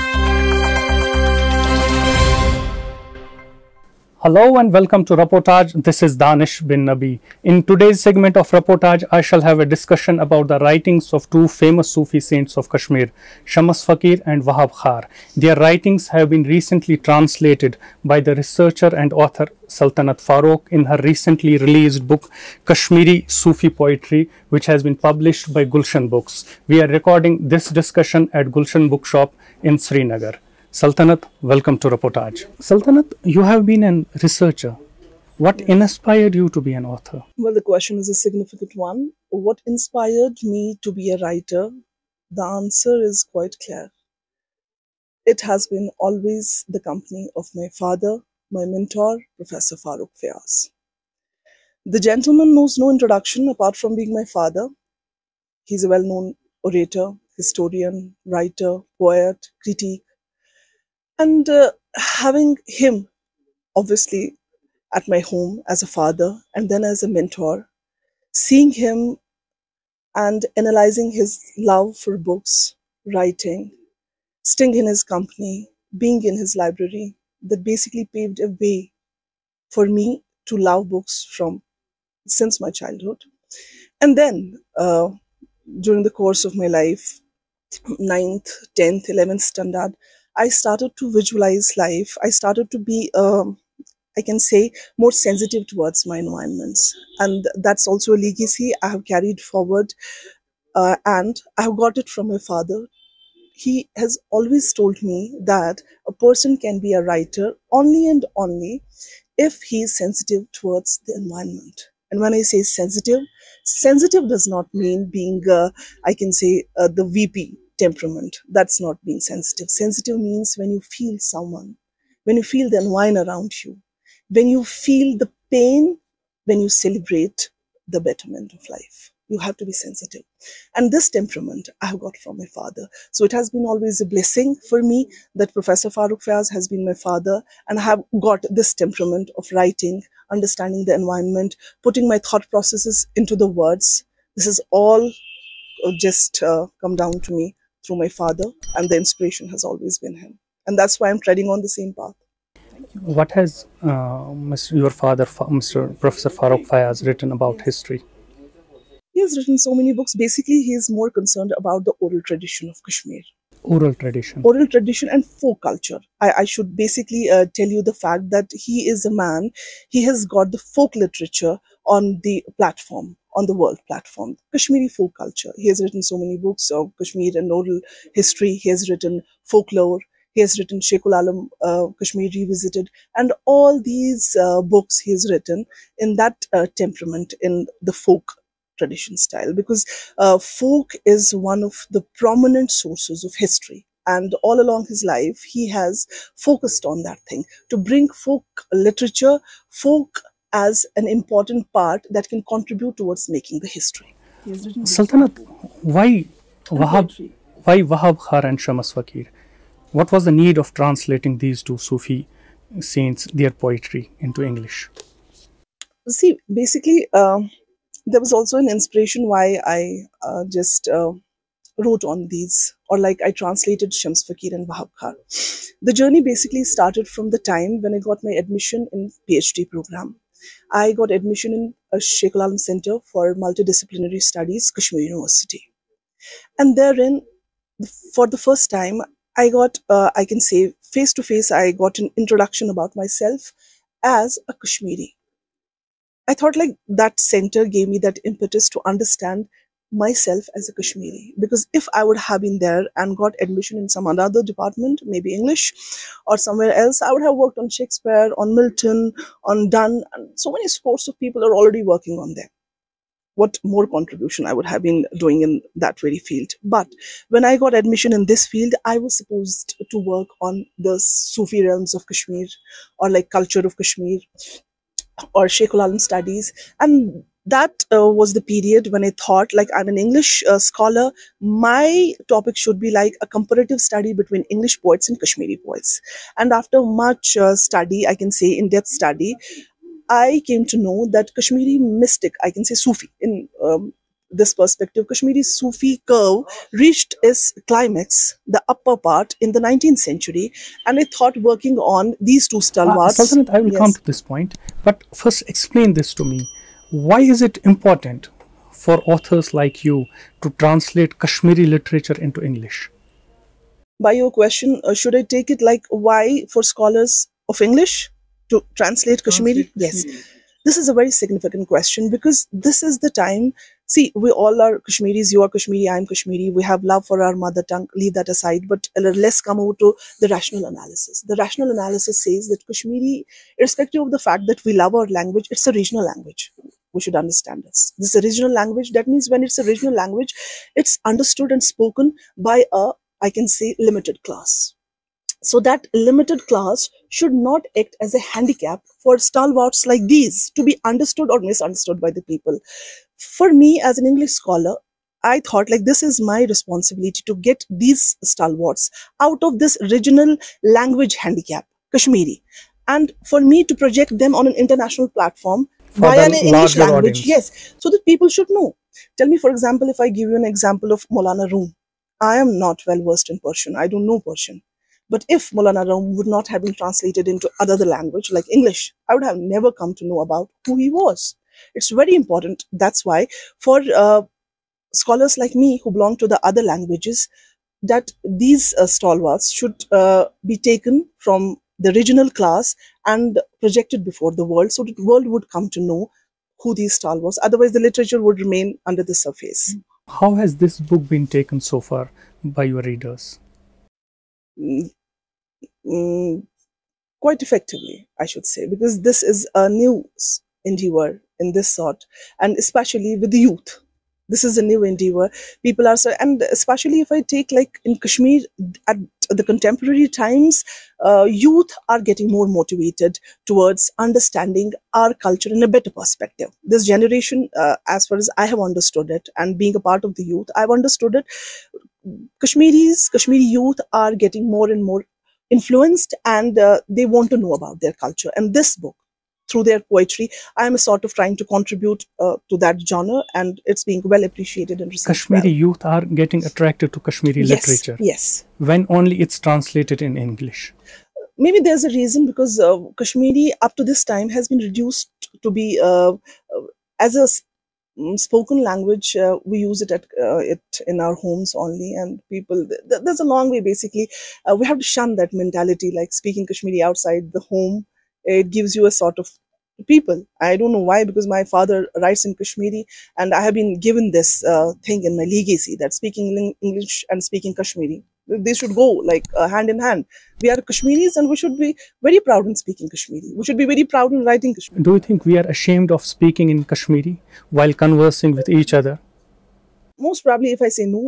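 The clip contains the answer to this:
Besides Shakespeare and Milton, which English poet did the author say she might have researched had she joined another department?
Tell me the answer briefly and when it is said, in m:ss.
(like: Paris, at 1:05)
Donne, at 4:19.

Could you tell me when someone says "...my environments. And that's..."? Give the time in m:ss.
1:36.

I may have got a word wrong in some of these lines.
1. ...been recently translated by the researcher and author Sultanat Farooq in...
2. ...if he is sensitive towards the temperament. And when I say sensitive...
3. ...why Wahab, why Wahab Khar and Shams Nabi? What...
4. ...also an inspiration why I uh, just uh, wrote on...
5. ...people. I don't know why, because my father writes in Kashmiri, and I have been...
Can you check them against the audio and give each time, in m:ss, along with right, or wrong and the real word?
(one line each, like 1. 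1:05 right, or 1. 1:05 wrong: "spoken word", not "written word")
1. 0:16 right
2. 1:49 wrong: "environment", not "temperament"
3. 3:25 wrong: "Fakir", not "Nabi"
4. 3:38 right
5. 7:49 right.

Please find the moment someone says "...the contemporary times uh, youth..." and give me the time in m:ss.
6:59.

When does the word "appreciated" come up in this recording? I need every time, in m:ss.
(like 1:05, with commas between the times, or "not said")
7:24.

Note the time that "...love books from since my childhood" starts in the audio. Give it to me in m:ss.
1:20.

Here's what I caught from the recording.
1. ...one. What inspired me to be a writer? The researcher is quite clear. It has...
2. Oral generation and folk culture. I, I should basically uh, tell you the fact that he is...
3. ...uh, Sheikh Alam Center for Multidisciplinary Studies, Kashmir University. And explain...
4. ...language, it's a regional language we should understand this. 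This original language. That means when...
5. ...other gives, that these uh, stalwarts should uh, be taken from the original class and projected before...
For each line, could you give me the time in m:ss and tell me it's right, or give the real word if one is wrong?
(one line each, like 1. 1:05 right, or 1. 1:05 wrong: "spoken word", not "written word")
1. 0:38 wrong: "answer", not "researcher"
2. 2:44 wrong: "tradition", not "generation"
3. 3:51 wrong: "therein", not "explain"
4. 5:35 right
5. 6:26 wrong: "languages", not "gives".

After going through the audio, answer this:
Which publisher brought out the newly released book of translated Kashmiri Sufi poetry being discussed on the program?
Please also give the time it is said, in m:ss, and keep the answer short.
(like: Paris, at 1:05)
Gulshan Books, at 0:25.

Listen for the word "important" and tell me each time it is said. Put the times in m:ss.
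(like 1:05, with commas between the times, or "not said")
3:21, 5:07, 6:22.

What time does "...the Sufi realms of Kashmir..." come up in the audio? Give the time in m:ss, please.
4:30.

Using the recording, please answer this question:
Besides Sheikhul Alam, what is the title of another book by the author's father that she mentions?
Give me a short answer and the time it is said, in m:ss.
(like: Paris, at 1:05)
Kashmir Revisited, at 3:01.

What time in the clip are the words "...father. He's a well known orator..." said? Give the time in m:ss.
0:54.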